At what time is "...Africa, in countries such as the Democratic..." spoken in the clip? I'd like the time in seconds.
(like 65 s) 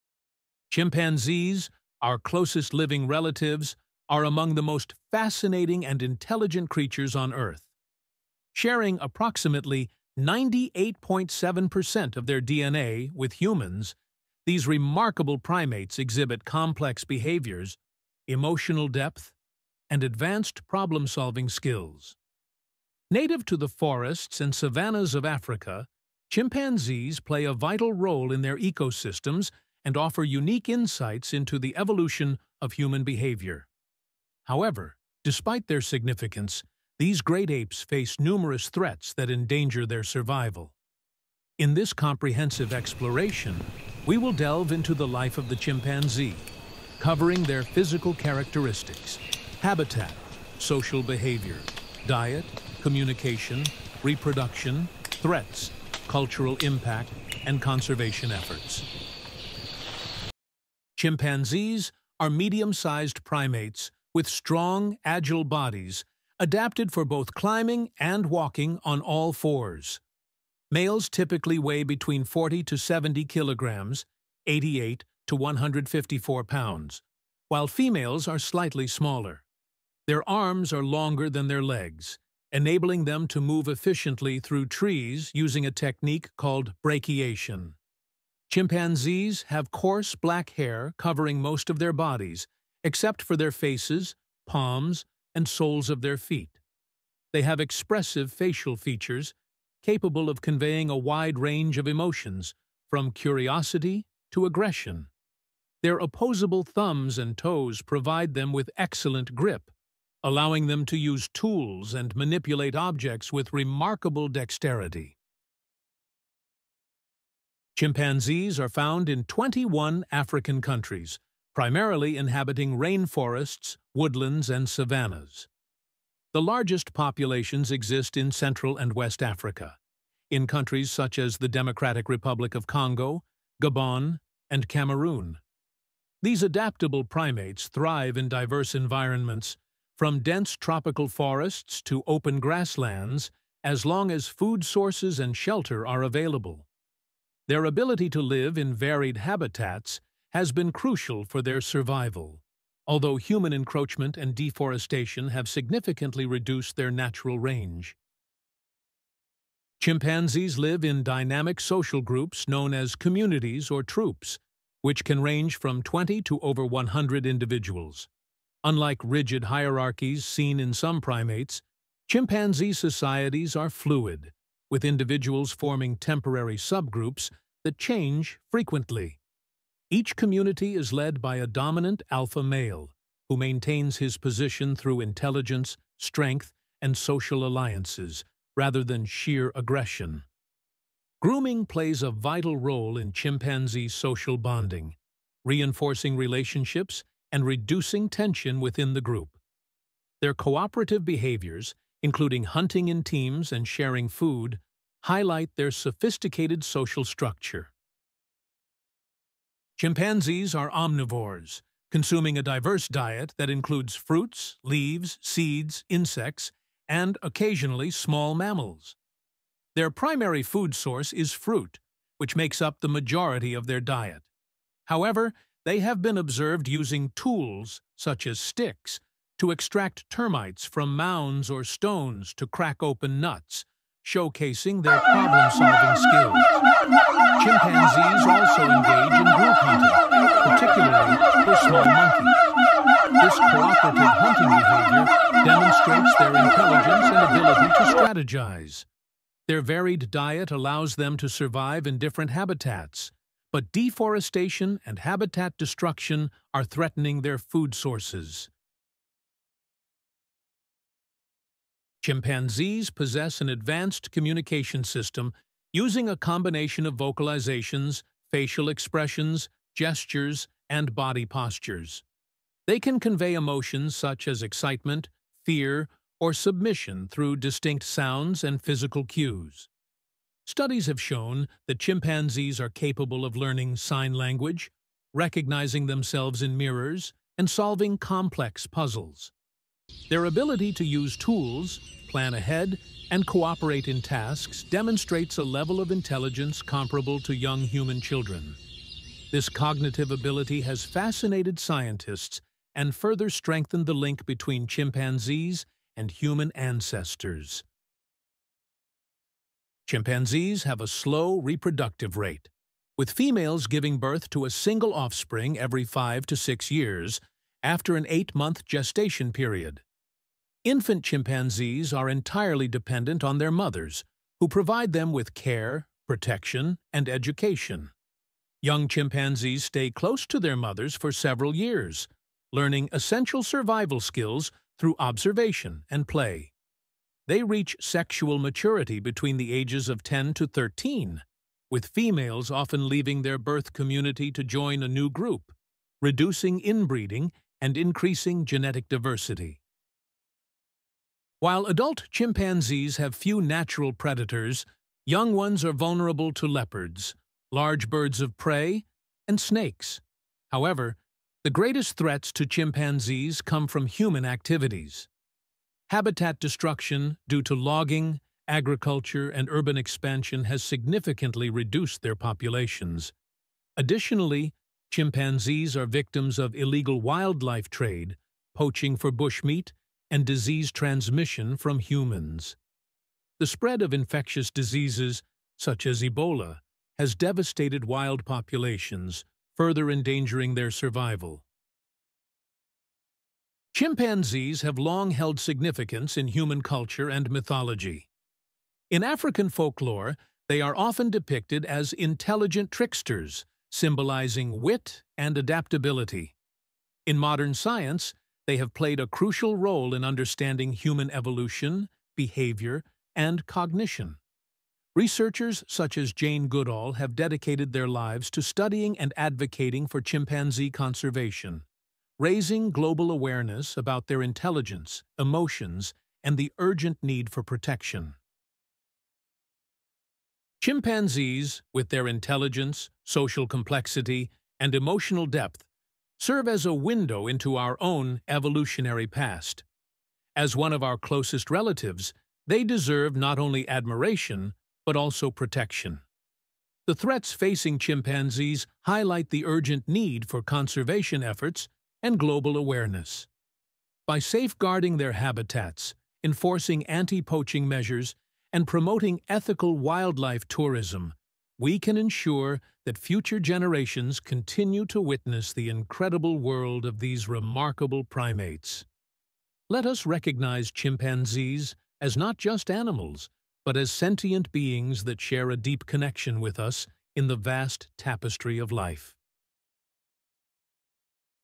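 129 s.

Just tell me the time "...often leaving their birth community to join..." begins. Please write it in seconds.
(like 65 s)
342 s.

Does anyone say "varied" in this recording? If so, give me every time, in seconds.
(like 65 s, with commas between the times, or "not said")
148 s, 249 s.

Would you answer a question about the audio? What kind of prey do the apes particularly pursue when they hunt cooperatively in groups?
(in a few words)
small monkeys.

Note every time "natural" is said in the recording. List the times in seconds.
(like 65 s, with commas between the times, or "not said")
156 s, 353 s.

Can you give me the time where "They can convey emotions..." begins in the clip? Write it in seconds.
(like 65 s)
272 s.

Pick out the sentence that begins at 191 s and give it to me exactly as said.
Grooming plays a vital role in chimpanzee social bonding, reinforcing relationships and reducing tension within the group.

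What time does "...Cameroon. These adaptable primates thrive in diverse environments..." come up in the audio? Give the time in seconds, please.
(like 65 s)
134 s.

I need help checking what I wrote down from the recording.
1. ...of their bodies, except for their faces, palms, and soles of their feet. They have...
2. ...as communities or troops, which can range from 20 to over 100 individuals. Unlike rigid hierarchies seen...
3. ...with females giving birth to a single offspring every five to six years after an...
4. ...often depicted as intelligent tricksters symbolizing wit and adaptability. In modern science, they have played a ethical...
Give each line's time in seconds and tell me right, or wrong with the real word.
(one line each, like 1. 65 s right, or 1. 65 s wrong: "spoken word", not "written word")
1. 91 s right
2. 162 s right
3. 312 s right
4. 400 s wrong: "crucial", not "ethical".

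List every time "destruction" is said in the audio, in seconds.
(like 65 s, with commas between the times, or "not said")
255 s, 366 s.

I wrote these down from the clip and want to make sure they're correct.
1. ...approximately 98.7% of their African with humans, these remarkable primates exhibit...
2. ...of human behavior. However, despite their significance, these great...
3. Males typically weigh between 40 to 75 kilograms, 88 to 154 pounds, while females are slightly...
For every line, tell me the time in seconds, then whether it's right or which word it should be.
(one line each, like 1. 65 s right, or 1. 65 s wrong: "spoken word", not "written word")
1. 9 s wrong: "DNA", not "African"
2. 32 s right
3. 70 s wrong: "70", not "75".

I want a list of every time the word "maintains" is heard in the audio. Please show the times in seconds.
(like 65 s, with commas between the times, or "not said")
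183 s.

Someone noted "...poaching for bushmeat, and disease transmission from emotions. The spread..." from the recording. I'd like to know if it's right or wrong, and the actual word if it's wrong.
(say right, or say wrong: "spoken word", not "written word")
wrong: "humans", not "emotions".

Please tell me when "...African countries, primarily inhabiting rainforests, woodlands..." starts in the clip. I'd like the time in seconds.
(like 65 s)
120 s.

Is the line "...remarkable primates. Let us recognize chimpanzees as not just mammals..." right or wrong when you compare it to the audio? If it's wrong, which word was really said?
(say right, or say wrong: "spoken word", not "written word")
wrong: "animals", not "mammals".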